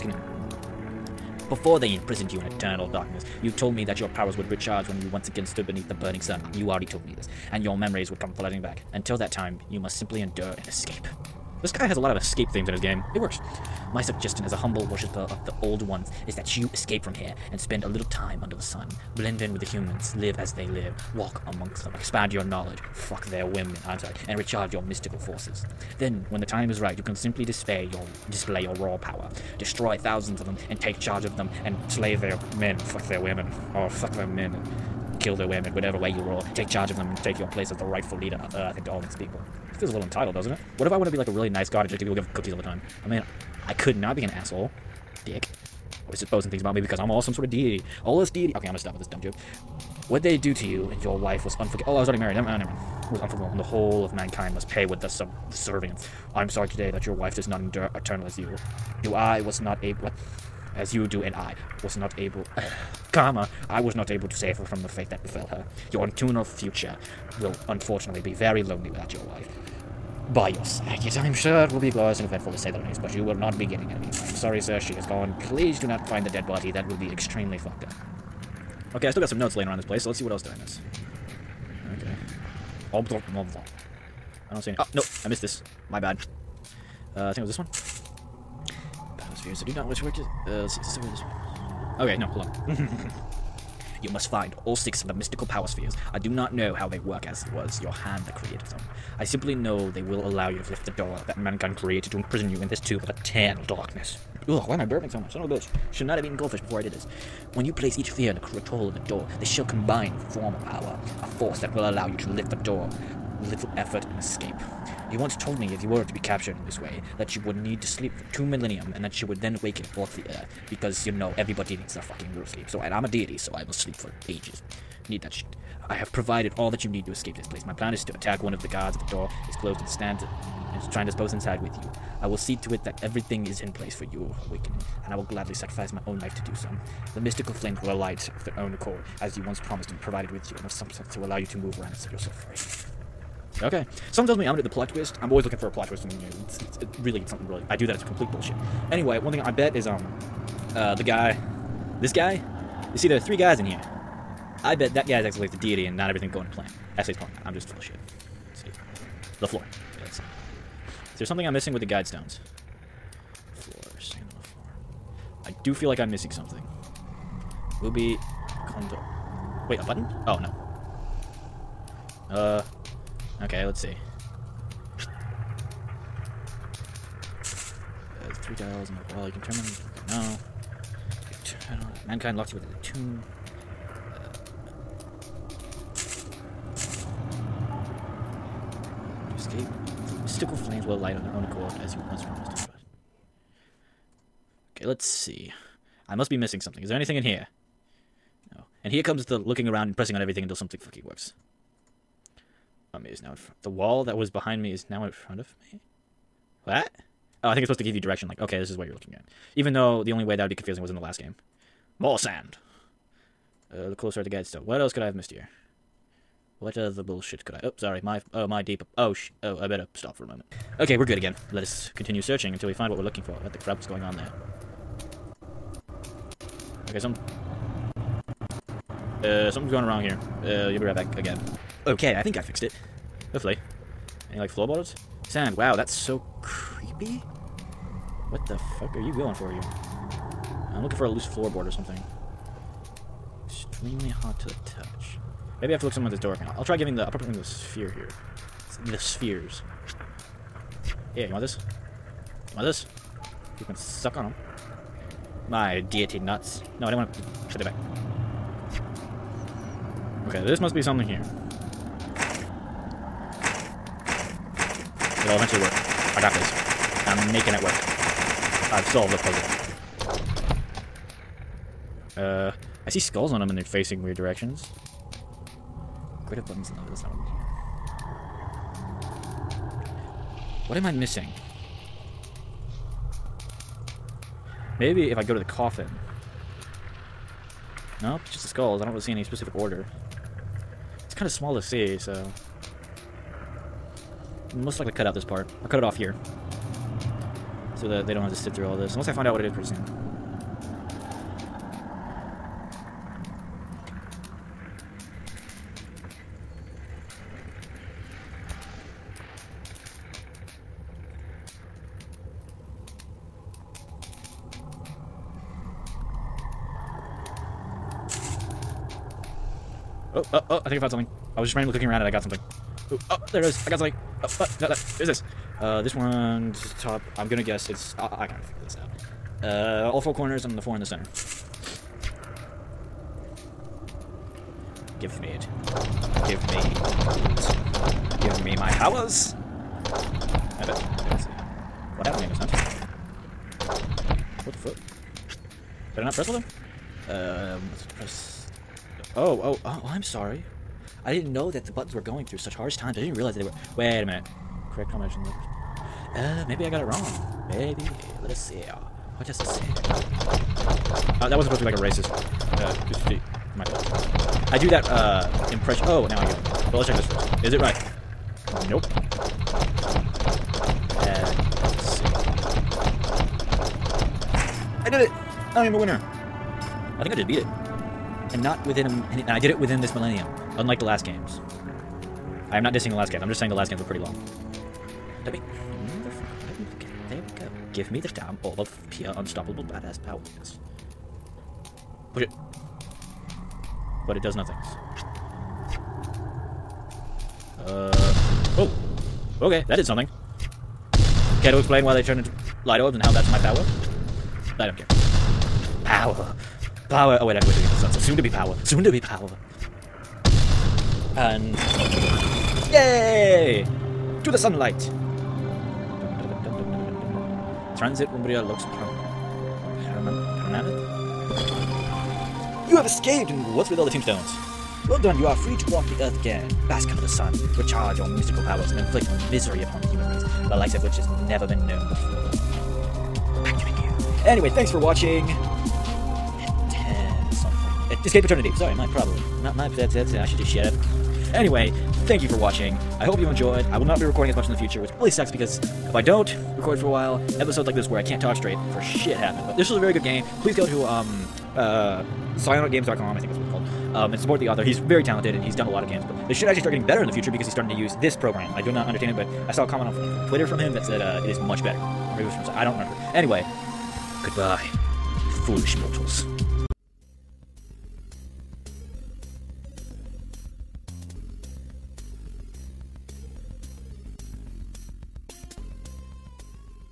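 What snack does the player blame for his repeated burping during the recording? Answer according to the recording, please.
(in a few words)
Goldfish.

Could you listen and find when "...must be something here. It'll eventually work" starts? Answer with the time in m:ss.
4:20.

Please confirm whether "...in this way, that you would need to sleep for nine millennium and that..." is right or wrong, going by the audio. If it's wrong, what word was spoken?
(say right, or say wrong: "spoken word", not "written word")
wrong: "two", not "nine".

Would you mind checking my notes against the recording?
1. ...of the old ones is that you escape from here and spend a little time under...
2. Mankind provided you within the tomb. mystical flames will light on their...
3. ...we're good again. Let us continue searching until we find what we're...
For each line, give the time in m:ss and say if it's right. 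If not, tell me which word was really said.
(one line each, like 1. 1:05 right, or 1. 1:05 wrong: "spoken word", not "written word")
1. 0:15 right
2. 3:02 wrong: "locked", not "provided"
3. 3:40 right.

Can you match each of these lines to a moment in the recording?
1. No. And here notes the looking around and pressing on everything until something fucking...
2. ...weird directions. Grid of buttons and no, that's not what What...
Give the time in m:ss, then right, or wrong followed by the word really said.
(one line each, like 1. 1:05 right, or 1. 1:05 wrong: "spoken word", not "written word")
1. 3:18 wrong: "comes", not "notes"
2. 4:34 right.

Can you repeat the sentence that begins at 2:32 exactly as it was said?
You see, there are three guys in here.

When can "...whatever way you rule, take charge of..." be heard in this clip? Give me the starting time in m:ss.
0:35.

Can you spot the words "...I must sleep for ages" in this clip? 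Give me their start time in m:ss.
2:03.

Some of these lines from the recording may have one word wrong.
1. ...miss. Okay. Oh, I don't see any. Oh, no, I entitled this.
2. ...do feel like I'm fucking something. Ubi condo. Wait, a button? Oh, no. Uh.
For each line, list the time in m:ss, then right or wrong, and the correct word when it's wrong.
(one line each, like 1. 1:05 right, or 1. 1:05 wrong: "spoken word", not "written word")
1. 1:20 wrong: "missed", not "entitled"
2. 2:45 wrong: "missing", not "fucking".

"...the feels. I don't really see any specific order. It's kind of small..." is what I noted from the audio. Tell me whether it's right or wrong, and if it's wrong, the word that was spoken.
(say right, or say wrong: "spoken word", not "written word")
wrong: "skulls", not "feels".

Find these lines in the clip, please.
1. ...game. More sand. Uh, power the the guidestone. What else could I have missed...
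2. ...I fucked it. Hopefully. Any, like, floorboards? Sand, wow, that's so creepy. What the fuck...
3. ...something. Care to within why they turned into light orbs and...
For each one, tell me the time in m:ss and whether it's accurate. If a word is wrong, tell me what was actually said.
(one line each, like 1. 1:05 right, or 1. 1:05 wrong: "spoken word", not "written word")
1. 3:31 wrong: "closer", not "power"
2. 3:52 wrong: "fixed", not "fucked"
3. 6:39 wrong: "explain", not "within".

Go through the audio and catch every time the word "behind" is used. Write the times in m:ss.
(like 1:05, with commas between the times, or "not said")
3:24.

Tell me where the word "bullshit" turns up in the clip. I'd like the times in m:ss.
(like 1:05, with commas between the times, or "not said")
2:28, 3:37.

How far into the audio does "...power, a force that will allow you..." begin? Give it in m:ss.
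1:50.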